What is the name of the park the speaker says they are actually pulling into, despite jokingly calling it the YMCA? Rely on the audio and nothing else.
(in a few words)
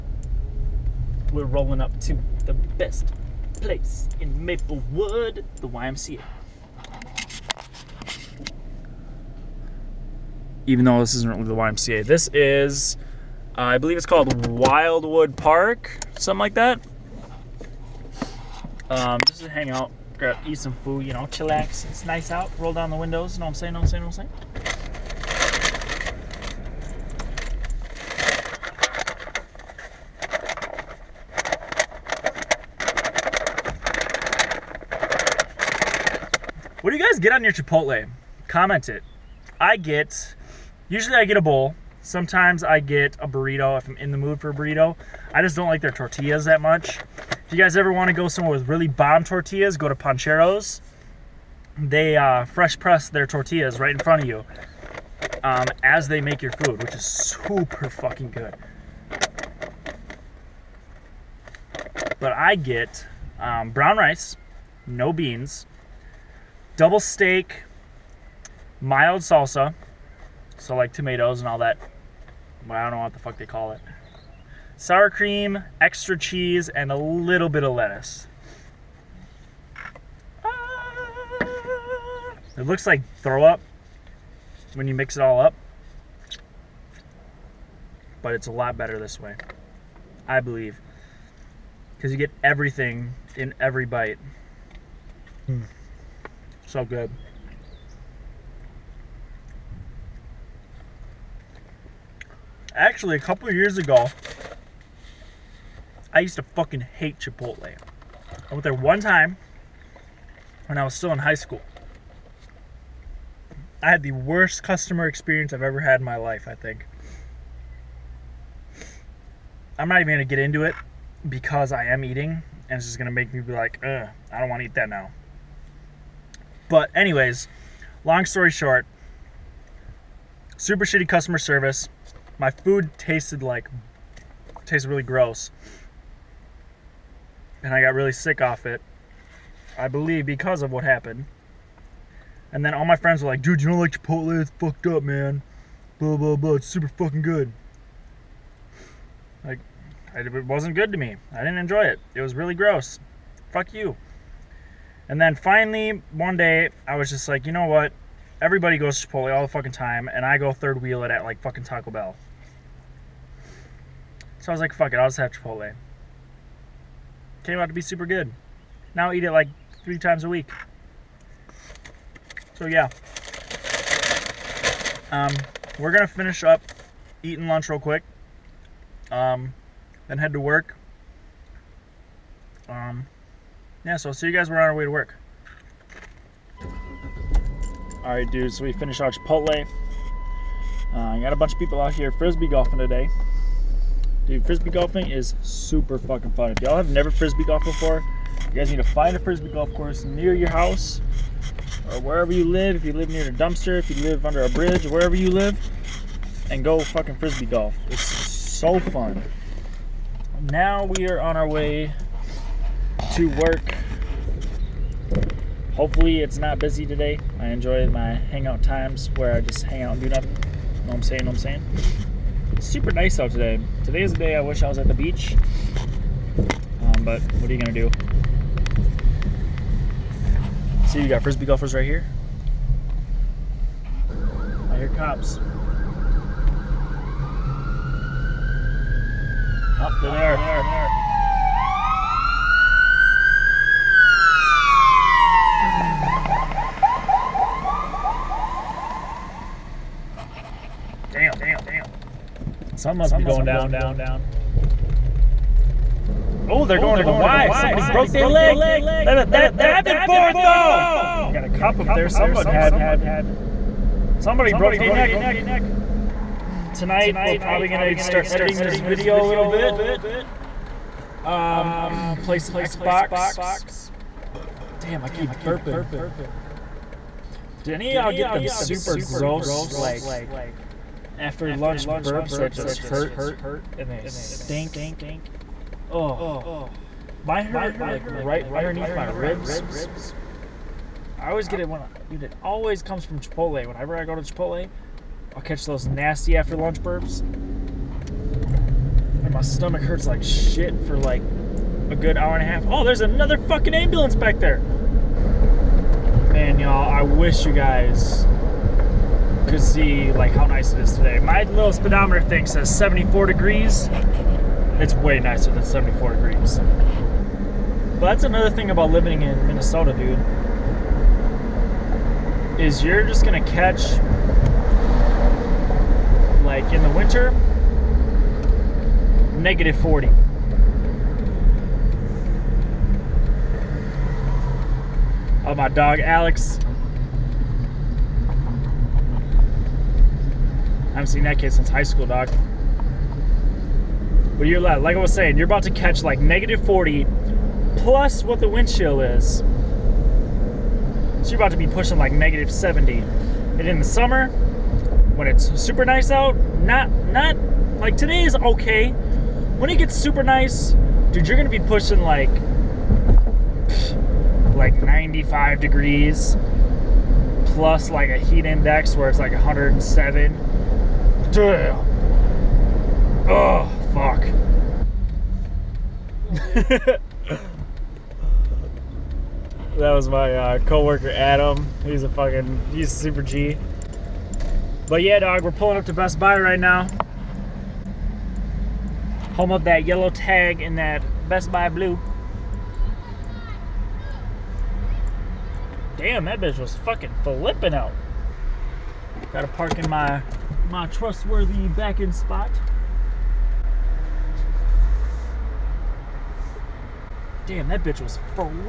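Wildwood Park.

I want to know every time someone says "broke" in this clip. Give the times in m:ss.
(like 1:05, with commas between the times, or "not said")
4:17, 4:24.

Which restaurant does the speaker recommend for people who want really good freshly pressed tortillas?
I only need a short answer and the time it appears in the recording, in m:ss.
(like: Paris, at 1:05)
Pancheros, at 0:49.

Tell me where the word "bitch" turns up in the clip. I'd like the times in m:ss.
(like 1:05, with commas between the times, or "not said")
6:36, 6:47.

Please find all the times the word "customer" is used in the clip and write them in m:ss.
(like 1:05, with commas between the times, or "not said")
1:54, 2:11.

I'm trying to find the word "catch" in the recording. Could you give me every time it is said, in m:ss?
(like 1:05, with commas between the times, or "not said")
4:55, 5:23, 5:45.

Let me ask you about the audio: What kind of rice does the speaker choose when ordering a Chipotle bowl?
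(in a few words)
brown rice.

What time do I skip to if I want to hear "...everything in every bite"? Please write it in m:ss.
1:32.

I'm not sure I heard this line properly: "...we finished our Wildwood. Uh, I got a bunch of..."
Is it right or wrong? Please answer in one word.
wrong.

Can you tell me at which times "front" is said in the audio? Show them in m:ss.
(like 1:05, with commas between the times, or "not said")
0:53.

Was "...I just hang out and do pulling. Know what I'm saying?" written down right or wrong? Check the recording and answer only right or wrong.
wrong.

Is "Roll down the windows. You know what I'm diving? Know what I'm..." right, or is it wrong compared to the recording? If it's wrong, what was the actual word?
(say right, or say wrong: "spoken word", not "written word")
wrong: "saying", not "diving".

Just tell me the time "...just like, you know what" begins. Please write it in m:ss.
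2:37.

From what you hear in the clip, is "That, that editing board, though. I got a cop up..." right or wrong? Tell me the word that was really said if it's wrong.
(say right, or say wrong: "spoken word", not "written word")
wrong: "diving", not "editing".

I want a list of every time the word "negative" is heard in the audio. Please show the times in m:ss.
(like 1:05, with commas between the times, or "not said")
5:29, 5:46, 5:52.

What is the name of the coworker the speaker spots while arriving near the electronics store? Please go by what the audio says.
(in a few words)
Adam.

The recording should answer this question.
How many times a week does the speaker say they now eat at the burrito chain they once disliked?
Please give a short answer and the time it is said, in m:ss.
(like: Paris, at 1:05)
3, at 2:49.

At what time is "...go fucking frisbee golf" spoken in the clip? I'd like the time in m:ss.
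3:26.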